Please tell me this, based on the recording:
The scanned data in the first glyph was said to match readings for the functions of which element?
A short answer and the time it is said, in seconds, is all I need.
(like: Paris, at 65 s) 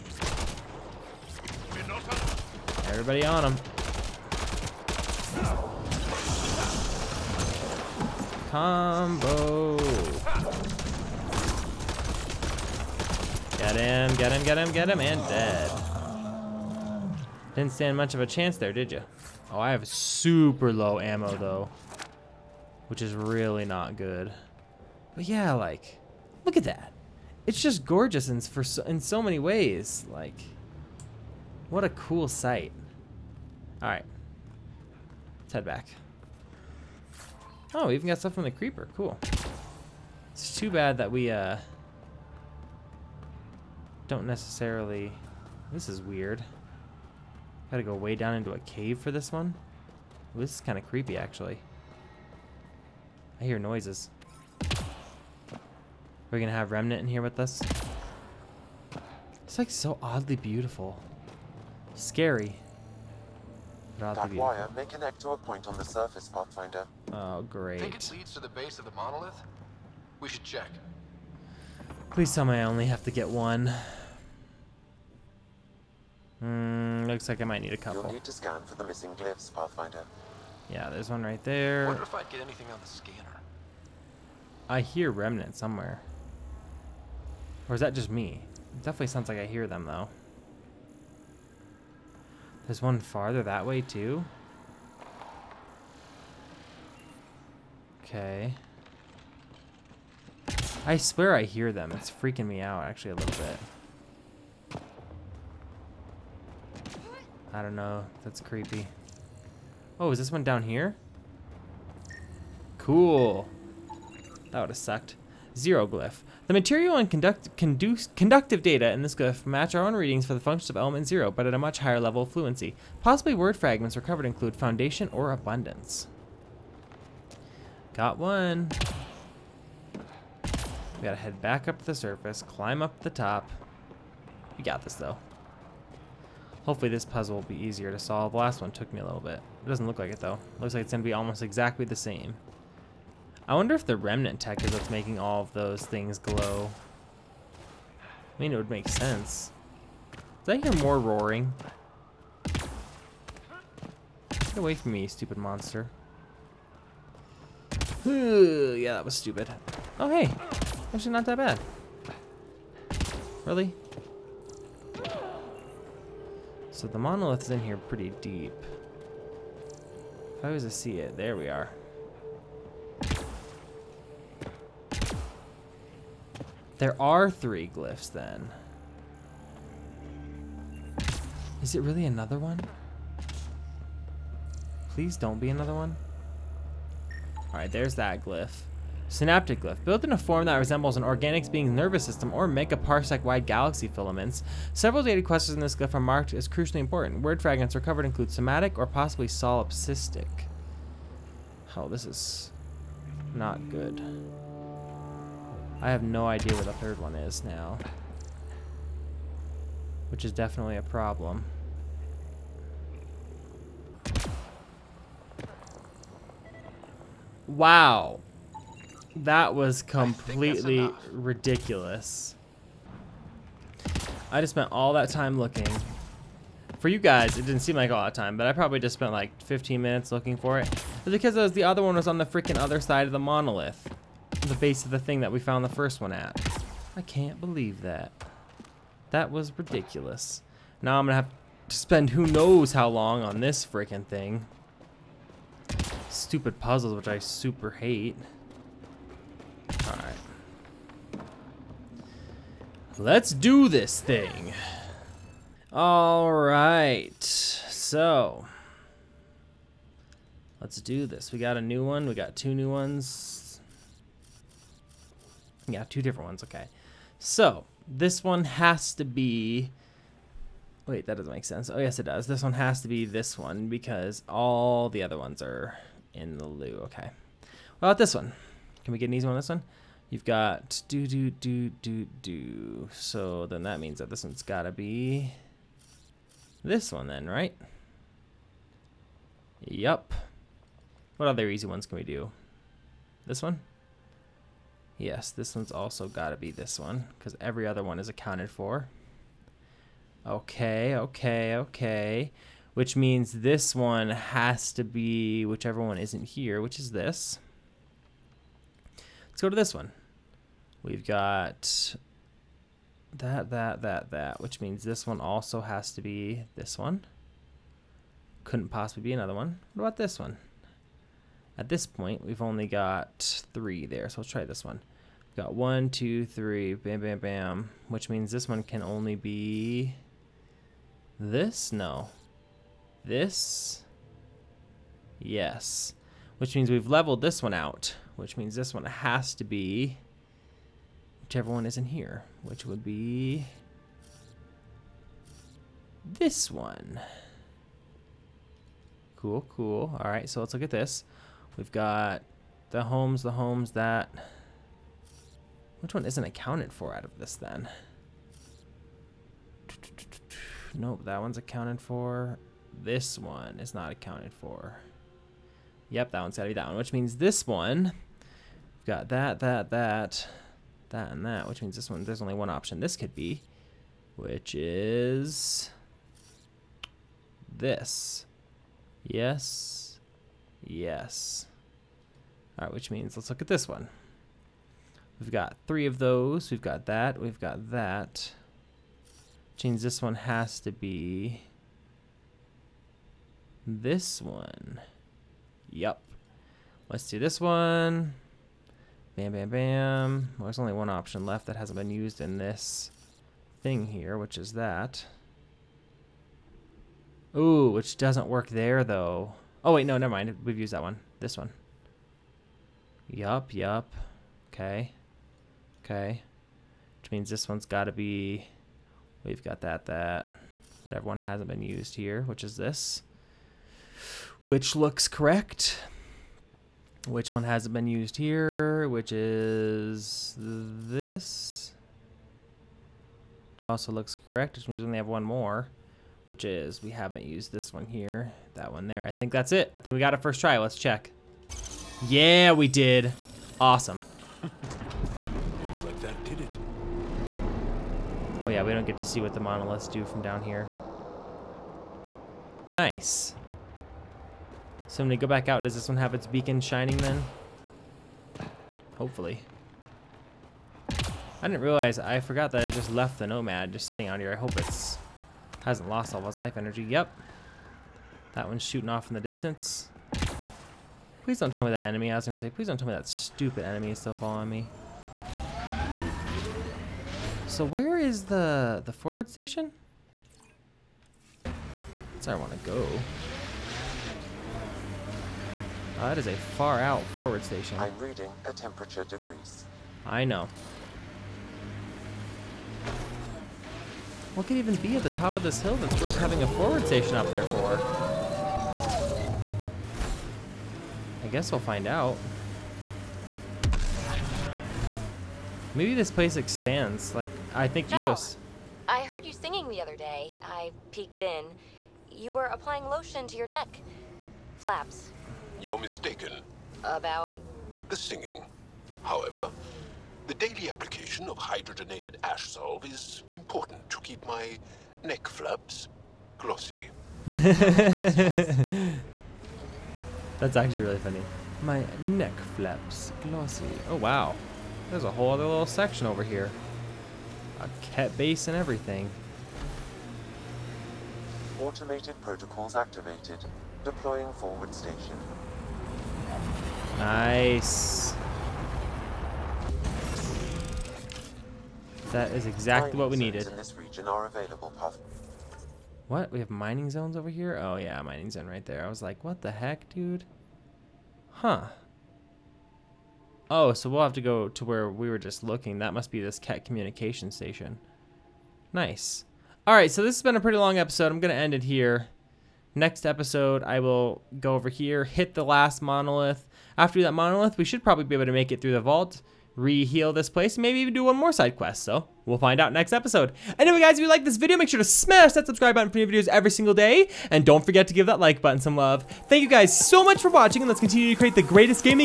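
Element zero, at 120 s.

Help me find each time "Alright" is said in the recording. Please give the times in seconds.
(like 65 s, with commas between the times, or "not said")
249 s, 255 s.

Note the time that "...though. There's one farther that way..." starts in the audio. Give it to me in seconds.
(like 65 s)
89 s.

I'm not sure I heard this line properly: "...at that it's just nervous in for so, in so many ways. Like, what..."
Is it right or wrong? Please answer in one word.
wrong.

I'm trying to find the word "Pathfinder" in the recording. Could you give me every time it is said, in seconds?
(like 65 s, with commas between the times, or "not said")
66 s, 79 s.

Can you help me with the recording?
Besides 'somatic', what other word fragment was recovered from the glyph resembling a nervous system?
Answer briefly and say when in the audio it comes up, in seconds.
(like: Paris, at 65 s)
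Solipsistic, at 199 s.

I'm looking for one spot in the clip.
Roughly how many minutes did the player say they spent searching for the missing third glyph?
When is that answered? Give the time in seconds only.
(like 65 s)
229 s.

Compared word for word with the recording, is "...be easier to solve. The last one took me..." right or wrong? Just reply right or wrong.
right.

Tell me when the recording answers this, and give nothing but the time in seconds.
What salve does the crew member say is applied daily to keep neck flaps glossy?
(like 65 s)
521 s.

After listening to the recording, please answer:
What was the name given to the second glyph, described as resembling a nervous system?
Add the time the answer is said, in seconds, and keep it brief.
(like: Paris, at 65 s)
Synaptic glyph, at 189 s.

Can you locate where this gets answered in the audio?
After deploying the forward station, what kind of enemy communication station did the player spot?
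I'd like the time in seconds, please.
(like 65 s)
566 s.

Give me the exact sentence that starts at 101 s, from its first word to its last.
It's freaking me out, actually, a little bit.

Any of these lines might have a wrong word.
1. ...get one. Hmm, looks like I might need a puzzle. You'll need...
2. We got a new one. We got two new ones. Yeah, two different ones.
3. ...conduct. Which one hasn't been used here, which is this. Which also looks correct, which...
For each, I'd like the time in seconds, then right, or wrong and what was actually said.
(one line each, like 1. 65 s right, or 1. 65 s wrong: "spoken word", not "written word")
1. 73 s wrong: "couple", not "puzzle"
2. 261 s right
3. 425 s wrong: "correct", not "conduct".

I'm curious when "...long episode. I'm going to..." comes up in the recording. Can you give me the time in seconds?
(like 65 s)
570 s.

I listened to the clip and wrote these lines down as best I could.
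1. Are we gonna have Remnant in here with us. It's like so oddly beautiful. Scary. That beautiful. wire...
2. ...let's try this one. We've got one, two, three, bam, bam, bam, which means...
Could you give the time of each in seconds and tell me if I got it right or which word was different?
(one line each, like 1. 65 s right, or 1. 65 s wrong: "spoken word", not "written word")
1. 56 s right
2. 324 s right.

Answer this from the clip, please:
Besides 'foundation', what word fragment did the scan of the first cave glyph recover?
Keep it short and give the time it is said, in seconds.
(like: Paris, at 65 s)
Abundance, at 125 s.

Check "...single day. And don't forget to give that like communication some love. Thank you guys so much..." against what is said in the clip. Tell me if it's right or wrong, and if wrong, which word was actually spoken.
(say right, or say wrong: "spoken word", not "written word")
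wrong: "button", not "communication".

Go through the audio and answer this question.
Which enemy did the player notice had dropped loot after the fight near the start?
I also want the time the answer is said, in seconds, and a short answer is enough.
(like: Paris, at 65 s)
The creeper, at 38 s.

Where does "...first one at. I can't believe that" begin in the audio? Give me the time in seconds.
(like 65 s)
235 s.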